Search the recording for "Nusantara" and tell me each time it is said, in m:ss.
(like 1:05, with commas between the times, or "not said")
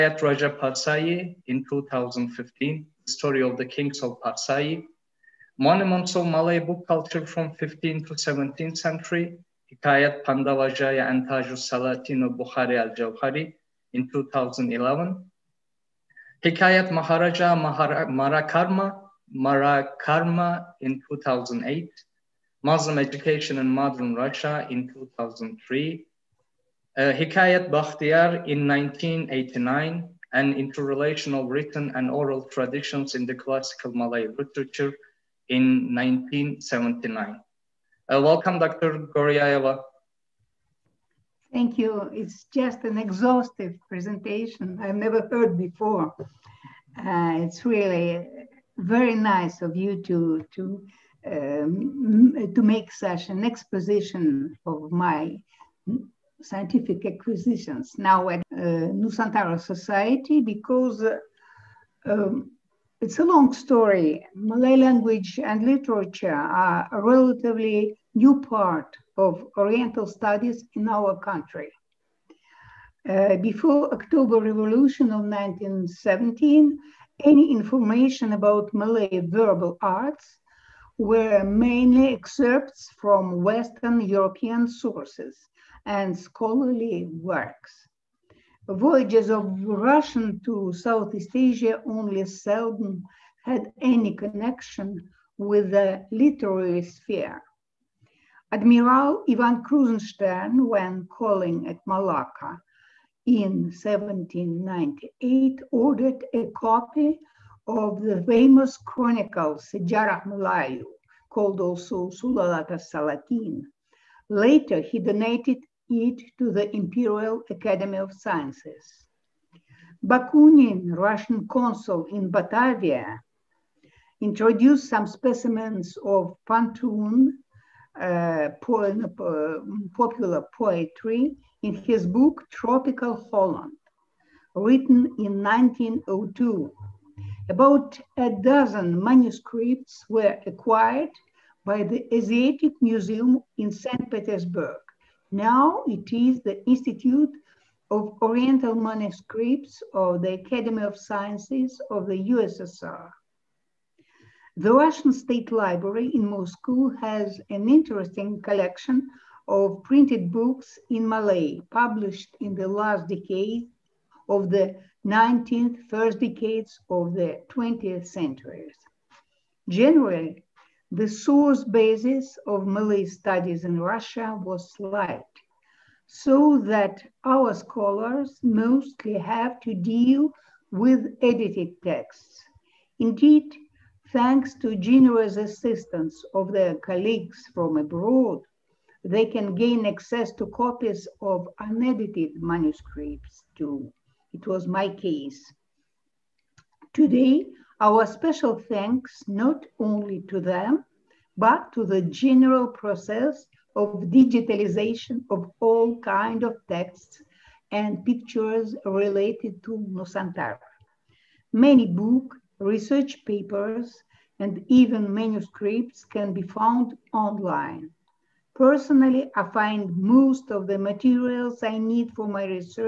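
0:58, 3:29.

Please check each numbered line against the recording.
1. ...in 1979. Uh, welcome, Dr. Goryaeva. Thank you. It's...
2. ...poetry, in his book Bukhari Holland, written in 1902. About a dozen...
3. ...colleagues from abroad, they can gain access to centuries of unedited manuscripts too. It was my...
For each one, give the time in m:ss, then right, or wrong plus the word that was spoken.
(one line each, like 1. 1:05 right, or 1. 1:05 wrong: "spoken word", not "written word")
1. 0:35 right
2. 2:10 wrong: "Tropical", not "Bukhari"
3. 3:06 wrong: "copies", not "centuries".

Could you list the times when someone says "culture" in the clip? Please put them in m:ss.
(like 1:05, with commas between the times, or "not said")
0:06.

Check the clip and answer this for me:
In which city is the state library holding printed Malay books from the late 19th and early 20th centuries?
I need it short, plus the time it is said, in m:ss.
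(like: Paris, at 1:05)
Moscow, at 2:36.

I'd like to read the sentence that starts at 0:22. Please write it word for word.
Muslim Education in Modern Russia in 2003.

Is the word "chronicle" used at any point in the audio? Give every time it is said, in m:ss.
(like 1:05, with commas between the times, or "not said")
1:48.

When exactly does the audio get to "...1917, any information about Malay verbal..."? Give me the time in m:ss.
1:15.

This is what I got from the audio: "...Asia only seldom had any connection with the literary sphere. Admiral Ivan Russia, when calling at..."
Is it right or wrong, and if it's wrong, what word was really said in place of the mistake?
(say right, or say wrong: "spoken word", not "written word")
wrong: "Krusenstern", not "Russia".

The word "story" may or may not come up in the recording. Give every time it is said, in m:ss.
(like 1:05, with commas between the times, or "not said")
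0:03, 1:03.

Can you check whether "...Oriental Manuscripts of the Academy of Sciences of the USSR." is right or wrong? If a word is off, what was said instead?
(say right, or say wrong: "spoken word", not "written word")
right.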